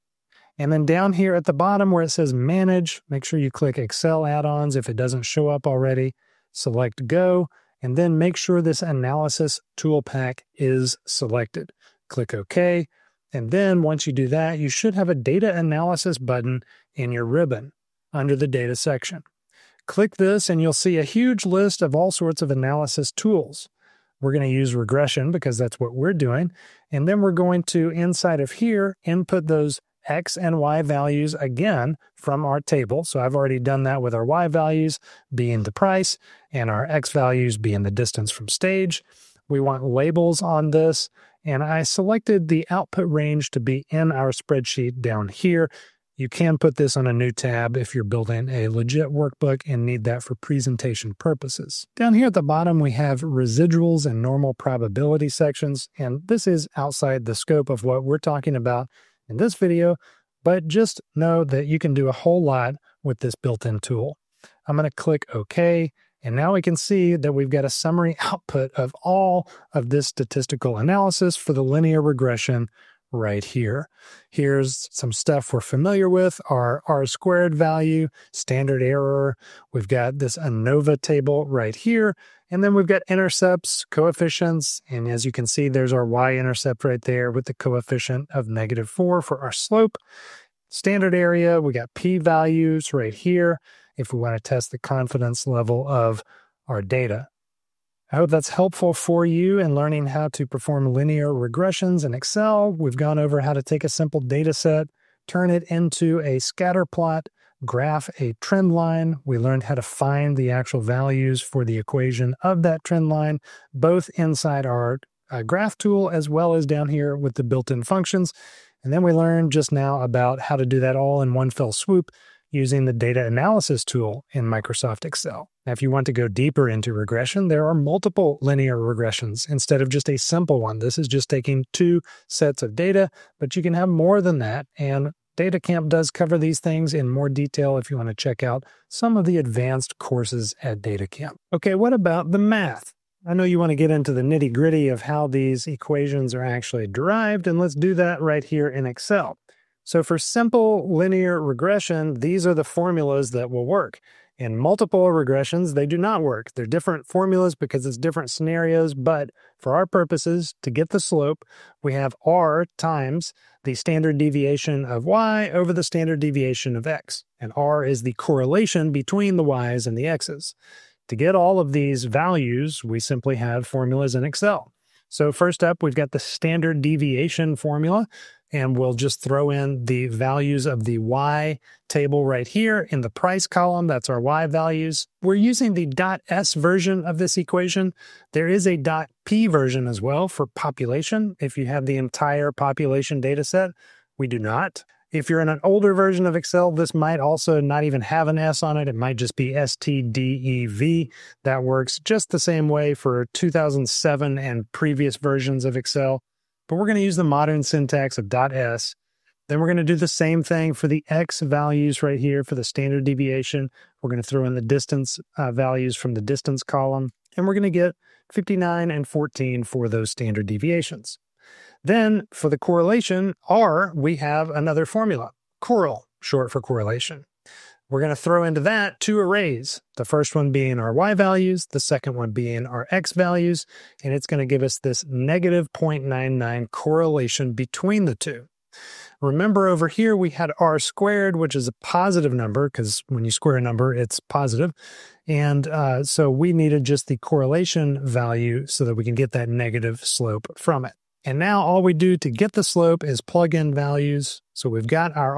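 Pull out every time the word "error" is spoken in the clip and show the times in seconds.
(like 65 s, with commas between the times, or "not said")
78 s, 91 s.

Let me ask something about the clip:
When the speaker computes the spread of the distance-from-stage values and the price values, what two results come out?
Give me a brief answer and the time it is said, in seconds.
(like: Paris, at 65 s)
59 and 14, at 218 s.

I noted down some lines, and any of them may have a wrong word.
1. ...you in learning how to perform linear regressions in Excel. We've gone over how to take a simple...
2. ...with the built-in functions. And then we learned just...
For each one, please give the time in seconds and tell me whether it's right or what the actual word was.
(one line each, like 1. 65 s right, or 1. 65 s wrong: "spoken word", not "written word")
1. 99 s right
2. 117 s right.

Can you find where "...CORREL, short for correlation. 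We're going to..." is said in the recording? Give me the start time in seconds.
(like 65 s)
225 s.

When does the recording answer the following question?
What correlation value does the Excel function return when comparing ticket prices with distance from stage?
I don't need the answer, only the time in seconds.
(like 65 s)
235 s.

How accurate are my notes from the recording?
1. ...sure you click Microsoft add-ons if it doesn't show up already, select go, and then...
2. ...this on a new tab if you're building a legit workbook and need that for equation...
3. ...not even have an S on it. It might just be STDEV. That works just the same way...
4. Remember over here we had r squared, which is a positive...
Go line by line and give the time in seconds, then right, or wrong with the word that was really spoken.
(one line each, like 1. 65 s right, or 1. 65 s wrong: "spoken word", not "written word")
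1. 3 s wrong: "Excel", not "Microsoft"
2. 46 s wrong: "presentation", not "equation"
3. 197 s right
4. 239 s right.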